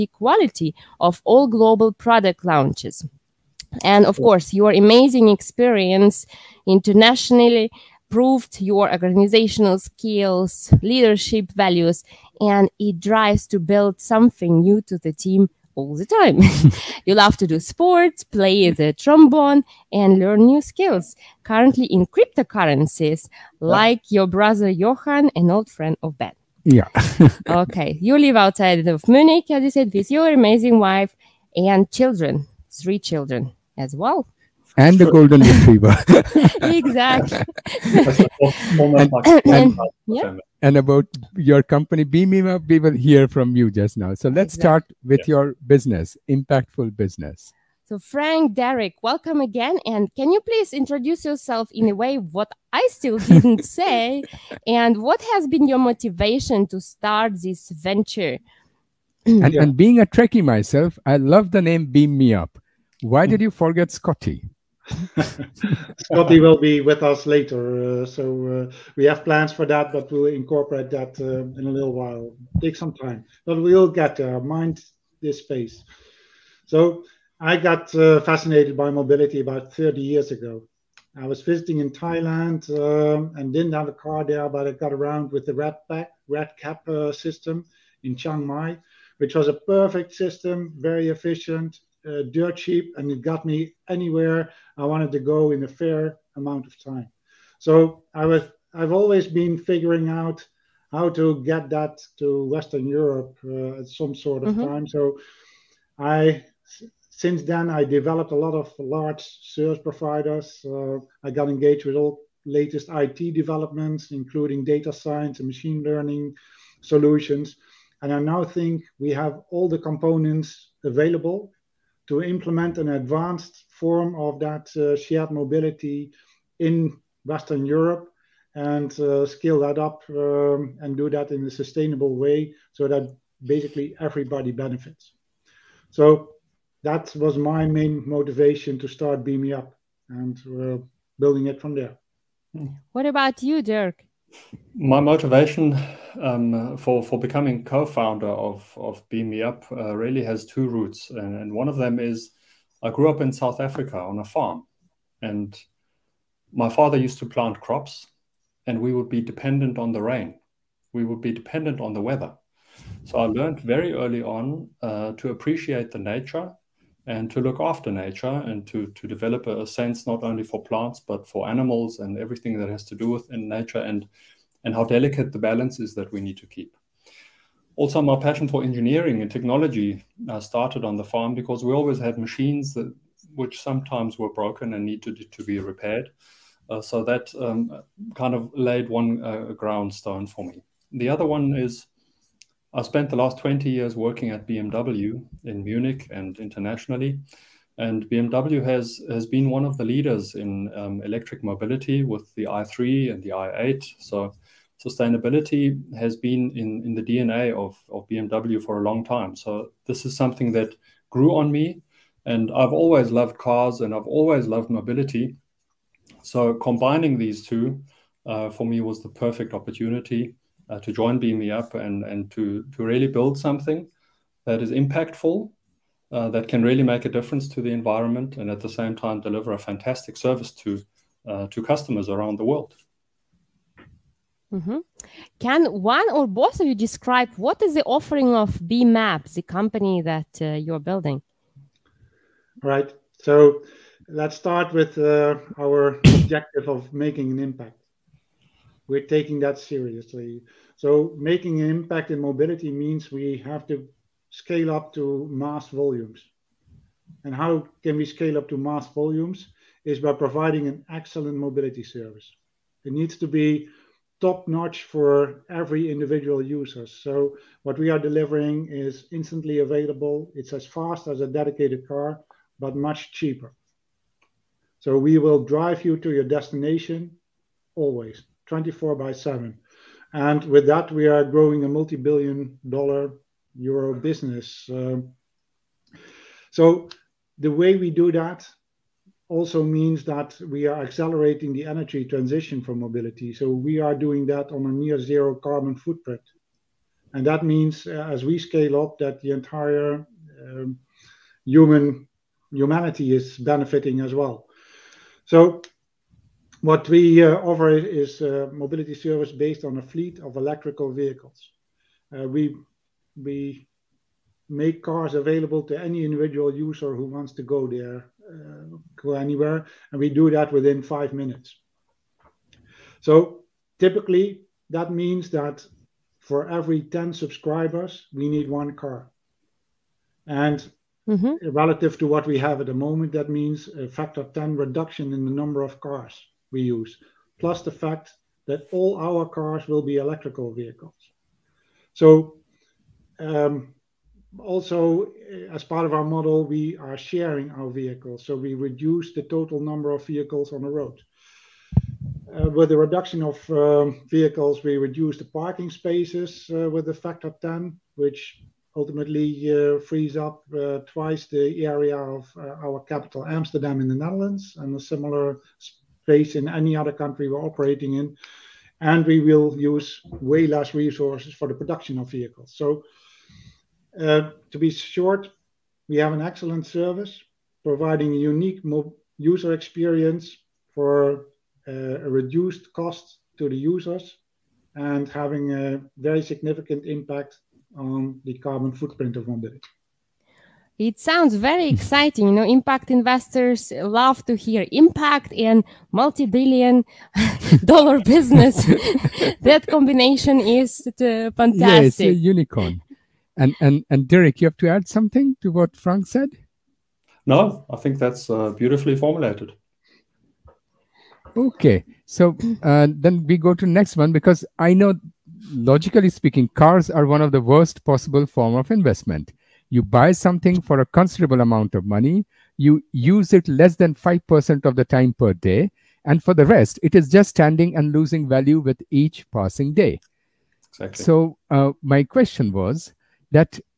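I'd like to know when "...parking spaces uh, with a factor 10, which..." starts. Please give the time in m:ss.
5:55.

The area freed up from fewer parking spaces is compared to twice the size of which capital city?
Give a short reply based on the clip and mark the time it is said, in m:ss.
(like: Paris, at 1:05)
Amsterdam, at 6:03.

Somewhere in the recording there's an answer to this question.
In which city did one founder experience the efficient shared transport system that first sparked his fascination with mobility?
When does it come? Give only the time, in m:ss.
1:28.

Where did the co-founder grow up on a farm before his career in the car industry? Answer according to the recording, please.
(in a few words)
South Africa.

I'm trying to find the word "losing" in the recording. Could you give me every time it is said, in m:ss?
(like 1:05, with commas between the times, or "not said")
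7:07.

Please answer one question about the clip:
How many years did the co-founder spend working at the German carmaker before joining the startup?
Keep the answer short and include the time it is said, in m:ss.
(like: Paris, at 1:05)
20, at 3:13.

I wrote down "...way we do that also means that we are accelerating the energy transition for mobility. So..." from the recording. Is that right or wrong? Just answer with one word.
right.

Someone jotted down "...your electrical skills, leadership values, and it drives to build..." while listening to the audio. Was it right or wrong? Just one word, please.
wrong.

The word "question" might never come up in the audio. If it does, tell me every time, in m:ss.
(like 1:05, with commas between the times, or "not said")
7:12.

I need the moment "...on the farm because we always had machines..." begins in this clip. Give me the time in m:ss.
3:00.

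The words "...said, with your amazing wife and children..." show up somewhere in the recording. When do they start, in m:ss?
0:29.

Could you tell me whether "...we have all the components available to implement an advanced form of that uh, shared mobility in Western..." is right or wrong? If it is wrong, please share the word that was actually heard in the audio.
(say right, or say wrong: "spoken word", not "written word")
right.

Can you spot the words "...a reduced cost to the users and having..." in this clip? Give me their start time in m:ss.
6:22.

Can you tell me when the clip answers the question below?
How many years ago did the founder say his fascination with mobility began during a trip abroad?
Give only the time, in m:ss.
1:19.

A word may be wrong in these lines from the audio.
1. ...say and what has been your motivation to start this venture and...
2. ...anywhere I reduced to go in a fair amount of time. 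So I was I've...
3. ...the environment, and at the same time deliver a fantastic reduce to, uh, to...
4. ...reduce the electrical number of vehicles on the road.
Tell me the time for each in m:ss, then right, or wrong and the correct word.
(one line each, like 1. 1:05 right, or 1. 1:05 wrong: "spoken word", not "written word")
1. 0:53 right
2. 1:33 wrong: "wanted", not "reduced"
3. 3:47 wrong: "service", not "reduce"
4. 5:48 wrong: "total", not "electrical".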